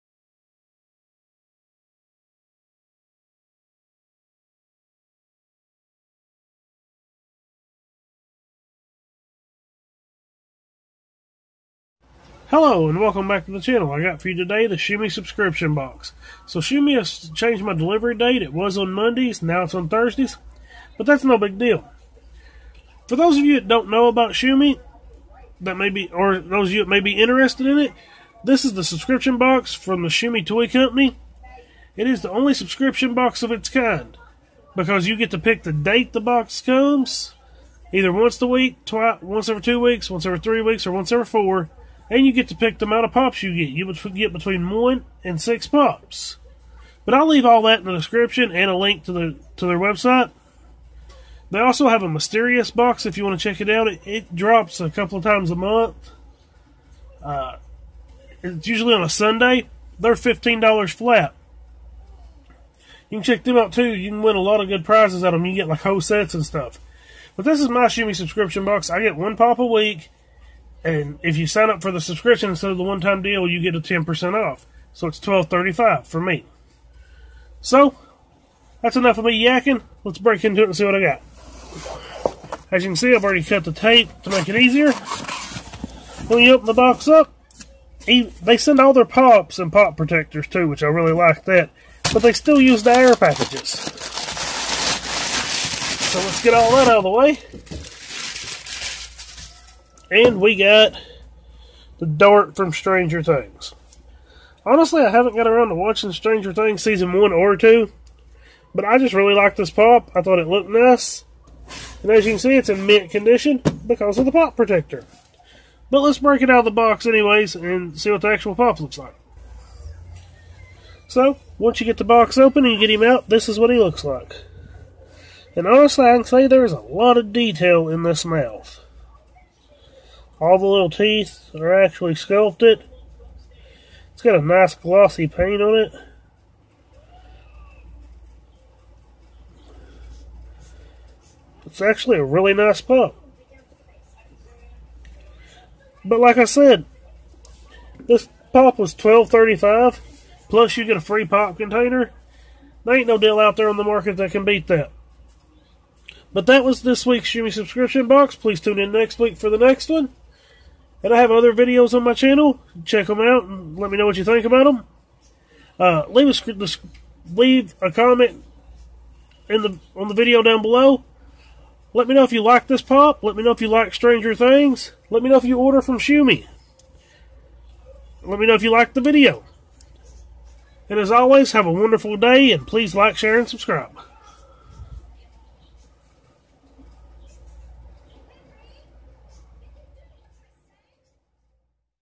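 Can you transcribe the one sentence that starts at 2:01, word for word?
So, once you get the box open and you get him out, this is what he looks like.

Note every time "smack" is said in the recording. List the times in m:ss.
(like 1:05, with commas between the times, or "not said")
not said.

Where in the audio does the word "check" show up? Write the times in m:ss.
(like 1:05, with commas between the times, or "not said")
0:53, 1:03, 2:42.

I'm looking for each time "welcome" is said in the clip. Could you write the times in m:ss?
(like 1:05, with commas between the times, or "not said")
0:12.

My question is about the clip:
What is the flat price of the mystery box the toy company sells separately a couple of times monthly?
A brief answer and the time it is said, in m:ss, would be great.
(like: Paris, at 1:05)
$15, at 1:00.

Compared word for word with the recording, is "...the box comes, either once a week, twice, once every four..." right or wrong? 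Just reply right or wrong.
wrong.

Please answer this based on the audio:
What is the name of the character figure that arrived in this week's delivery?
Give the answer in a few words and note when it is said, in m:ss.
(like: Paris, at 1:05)
Dart, at 1:42.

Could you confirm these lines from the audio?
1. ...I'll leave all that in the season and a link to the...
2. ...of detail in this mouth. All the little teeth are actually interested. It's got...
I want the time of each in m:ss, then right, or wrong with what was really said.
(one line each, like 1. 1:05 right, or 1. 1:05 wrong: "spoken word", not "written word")
1. 0:47 wrong: "description", not "season"
2. 2:07 wrong: "sculpted", not "interested".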